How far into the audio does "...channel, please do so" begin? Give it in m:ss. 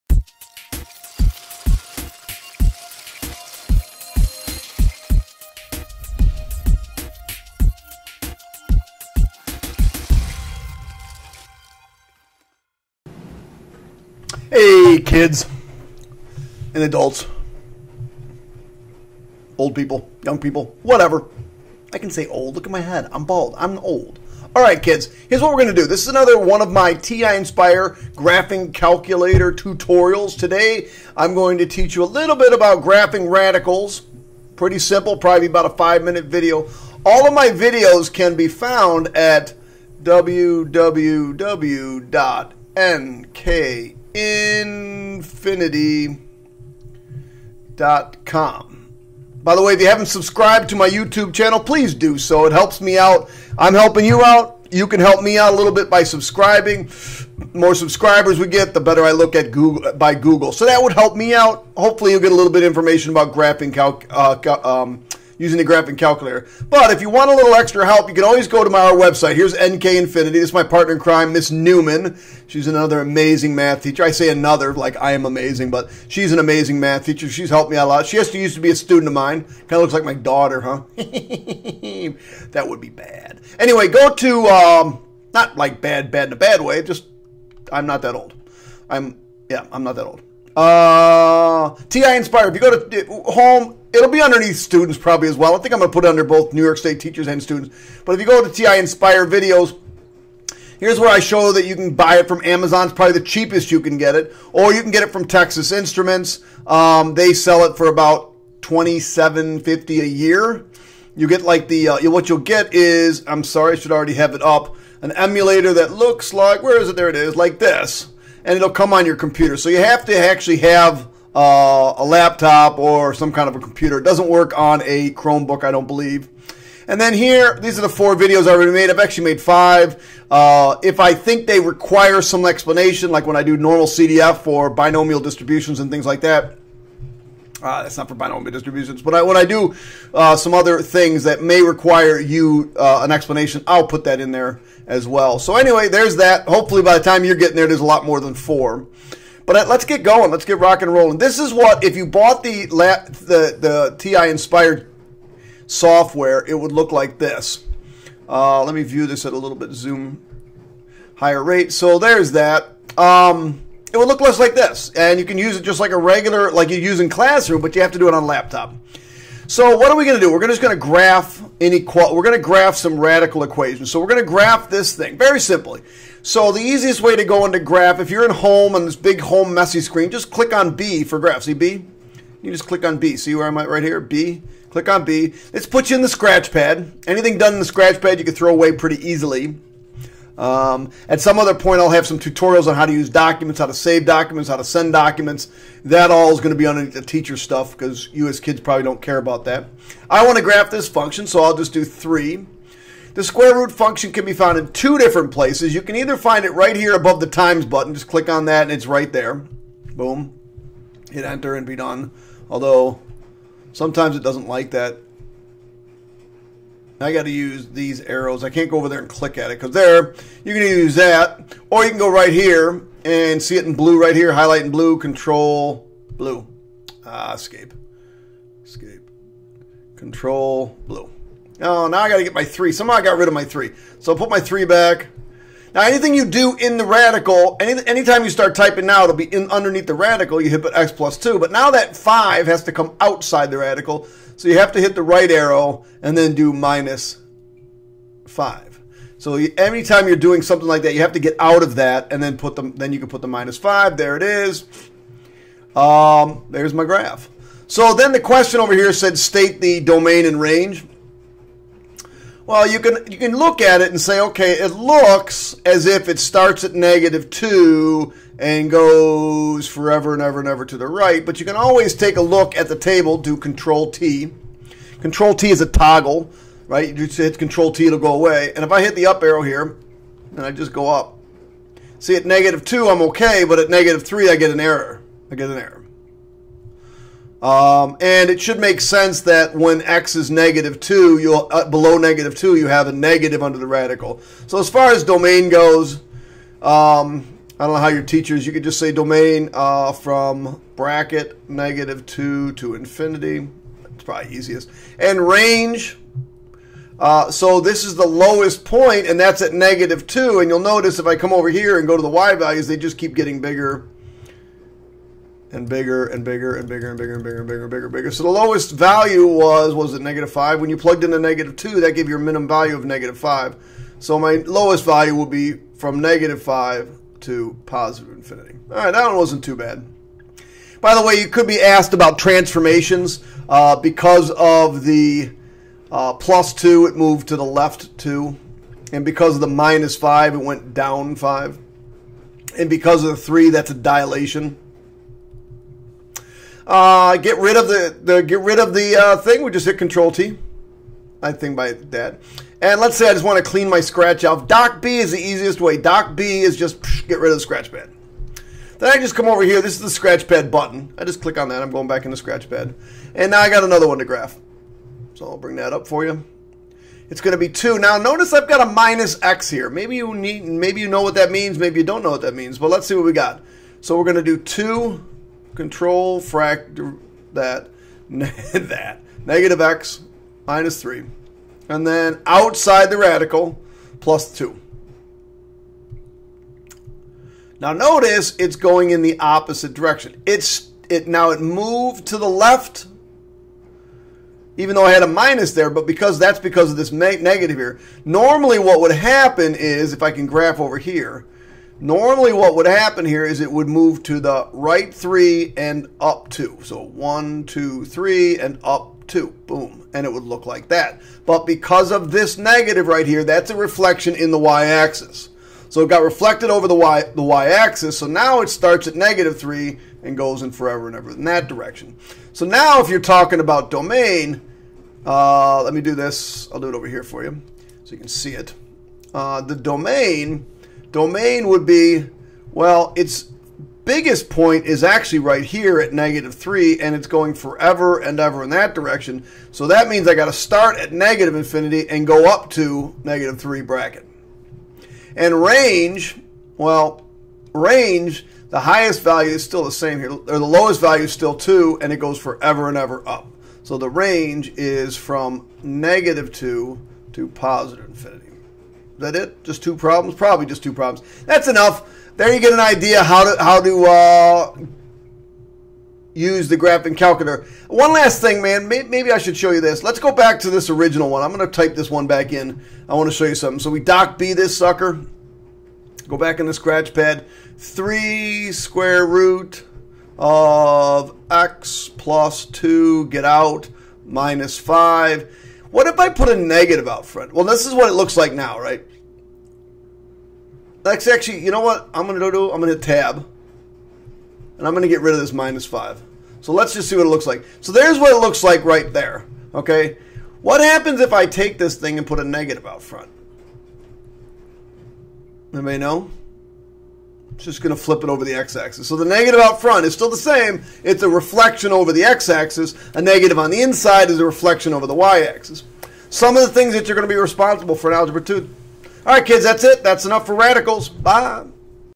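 0:51.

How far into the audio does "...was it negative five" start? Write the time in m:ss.
5:19.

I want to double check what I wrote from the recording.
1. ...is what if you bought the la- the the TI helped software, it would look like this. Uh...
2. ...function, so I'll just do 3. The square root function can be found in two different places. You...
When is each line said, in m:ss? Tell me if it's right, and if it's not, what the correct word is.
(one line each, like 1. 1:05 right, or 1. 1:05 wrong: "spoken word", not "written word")
1. 2:31 wrong: "inspired", not "helped"
2. 3:20 right.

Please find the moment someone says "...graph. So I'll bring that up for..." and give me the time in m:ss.
6:04.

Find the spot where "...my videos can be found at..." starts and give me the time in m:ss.
0:37.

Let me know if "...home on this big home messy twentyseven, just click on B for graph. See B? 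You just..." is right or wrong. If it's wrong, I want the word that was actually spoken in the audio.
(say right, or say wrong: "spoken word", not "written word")
wrong: "screen", not "twentyseven".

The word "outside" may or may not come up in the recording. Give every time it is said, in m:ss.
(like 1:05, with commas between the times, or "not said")
4:02, 6:22.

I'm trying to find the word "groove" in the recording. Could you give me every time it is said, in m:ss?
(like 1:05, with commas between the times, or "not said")
not said.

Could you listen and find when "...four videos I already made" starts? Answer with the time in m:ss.
2:07.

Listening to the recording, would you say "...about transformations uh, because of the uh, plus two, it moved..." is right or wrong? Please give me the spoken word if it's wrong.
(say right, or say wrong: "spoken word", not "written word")
right.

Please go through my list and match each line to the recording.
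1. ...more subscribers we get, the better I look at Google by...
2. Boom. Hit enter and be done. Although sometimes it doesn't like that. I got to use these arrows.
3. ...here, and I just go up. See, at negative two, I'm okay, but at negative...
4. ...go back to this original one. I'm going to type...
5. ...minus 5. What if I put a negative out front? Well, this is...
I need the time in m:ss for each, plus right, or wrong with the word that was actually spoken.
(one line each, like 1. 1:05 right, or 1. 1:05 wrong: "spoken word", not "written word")
1. 0:57 right
2. 3:29 right
3. 4:39 right
4. 7:49 right
5. 8:04 right.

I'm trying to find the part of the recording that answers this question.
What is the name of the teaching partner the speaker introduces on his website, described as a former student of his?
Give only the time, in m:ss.
1:11.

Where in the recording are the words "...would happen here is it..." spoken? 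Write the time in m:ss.
6:42.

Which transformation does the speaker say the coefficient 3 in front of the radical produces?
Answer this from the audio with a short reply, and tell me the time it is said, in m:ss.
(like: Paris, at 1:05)
Dilation, at 5:43.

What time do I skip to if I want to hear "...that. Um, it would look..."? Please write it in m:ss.
2:42.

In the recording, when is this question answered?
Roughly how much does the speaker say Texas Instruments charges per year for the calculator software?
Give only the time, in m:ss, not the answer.
1:48.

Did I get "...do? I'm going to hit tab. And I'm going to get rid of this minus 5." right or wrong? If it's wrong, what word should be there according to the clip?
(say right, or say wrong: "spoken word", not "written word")
right.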